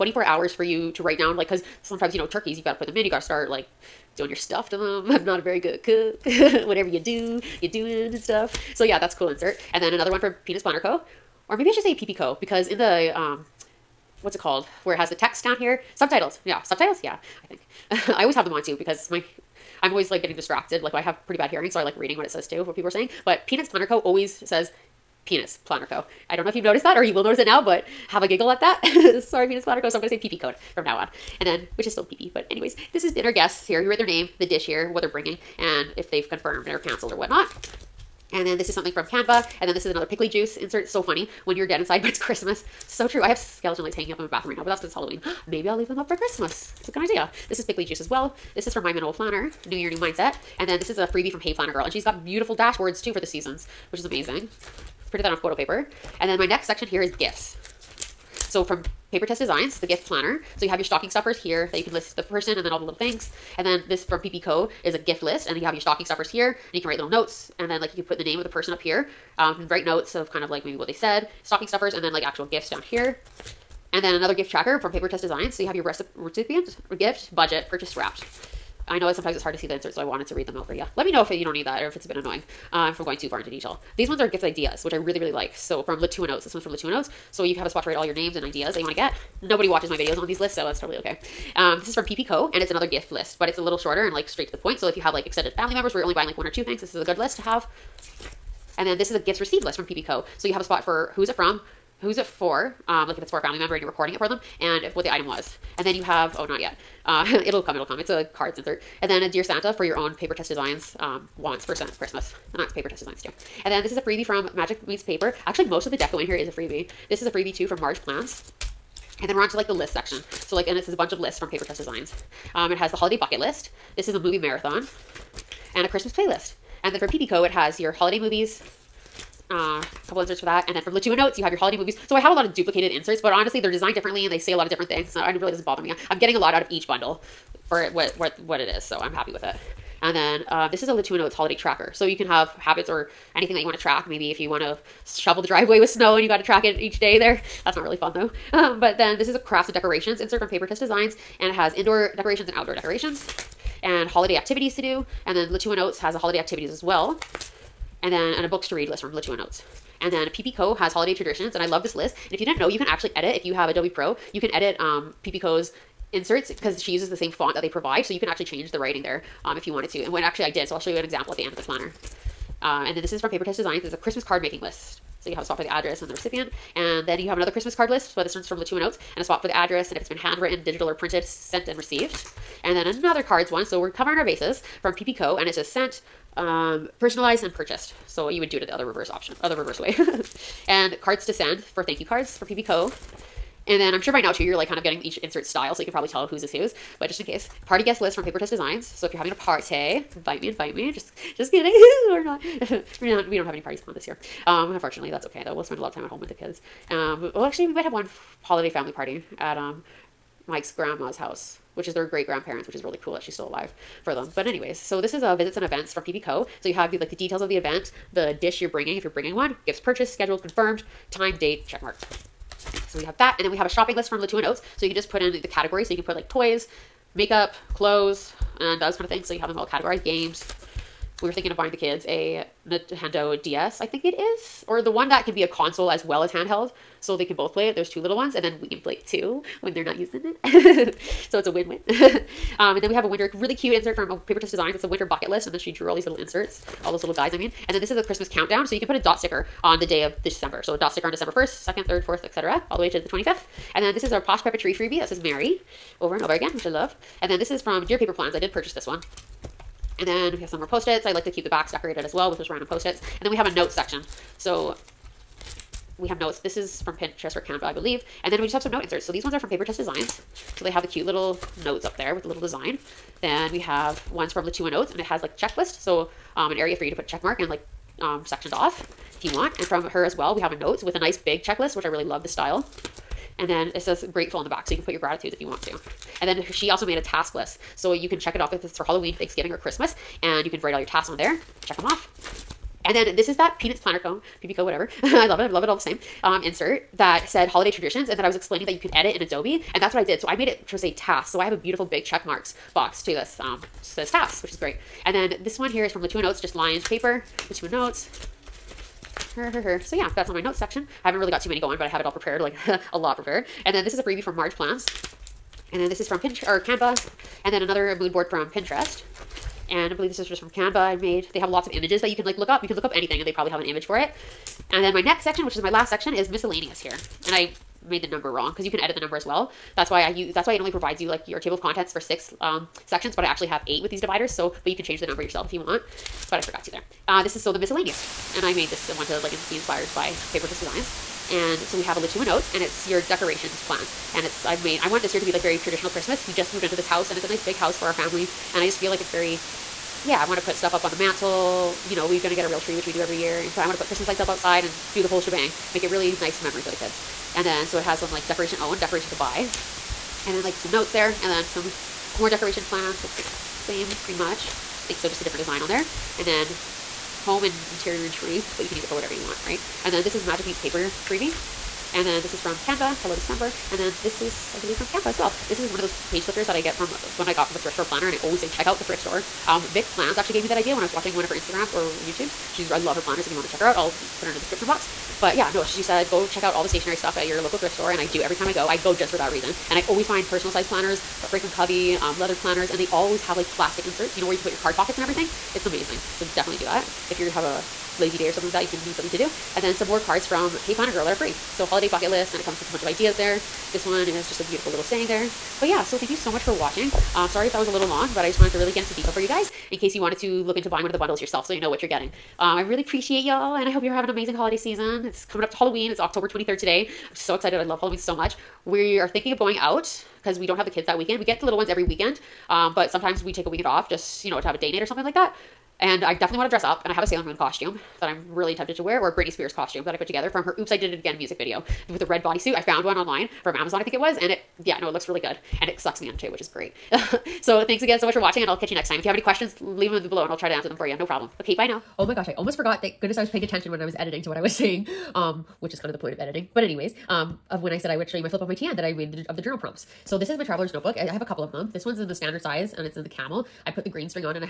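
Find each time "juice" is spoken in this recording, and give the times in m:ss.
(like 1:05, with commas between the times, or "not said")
0:40, 0:47.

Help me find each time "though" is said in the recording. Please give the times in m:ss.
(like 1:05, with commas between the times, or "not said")
2:28, 3:25.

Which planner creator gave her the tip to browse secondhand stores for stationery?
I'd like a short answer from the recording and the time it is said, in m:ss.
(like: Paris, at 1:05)
Vic Plans, at 6:19.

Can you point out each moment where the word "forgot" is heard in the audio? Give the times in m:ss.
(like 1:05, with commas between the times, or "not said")
5:36, 7:22.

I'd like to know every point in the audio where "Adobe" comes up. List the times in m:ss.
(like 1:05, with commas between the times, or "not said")
2:43, 4:59.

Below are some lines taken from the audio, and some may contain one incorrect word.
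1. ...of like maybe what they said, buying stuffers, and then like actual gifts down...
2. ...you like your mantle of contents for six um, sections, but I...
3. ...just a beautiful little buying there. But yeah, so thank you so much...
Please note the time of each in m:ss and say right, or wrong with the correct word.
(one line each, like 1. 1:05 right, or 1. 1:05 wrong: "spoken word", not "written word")
1. 1:10 wrong: "stocking", not "buying"
2. 5:30 wrong: "table", not "mantle"
3. 6:44 wrong: "saying", not "buying".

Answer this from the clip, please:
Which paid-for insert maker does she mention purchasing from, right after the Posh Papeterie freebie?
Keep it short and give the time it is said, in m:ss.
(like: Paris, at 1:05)
Dear Paper Plans, at 4:17.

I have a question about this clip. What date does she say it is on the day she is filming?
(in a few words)
October 23.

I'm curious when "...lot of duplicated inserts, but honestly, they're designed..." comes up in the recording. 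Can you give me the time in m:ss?
2:12.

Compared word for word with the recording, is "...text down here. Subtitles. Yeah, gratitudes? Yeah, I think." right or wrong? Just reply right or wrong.
wrong.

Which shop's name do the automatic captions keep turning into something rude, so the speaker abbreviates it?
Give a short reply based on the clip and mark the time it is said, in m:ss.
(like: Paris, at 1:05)
Peanuts Planner Co., at 0:23.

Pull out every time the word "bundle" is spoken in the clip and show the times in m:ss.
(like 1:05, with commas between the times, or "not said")
2:16, 6:50.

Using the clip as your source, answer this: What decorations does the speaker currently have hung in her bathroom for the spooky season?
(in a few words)
Skeleton lights.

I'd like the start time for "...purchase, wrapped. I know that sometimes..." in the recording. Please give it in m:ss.
1:17.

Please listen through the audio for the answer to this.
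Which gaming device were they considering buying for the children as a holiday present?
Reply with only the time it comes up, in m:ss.
3:52.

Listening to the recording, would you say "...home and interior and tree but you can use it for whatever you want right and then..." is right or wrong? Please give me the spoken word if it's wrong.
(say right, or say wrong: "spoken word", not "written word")
right.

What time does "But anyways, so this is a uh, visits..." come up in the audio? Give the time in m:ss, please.
3:34.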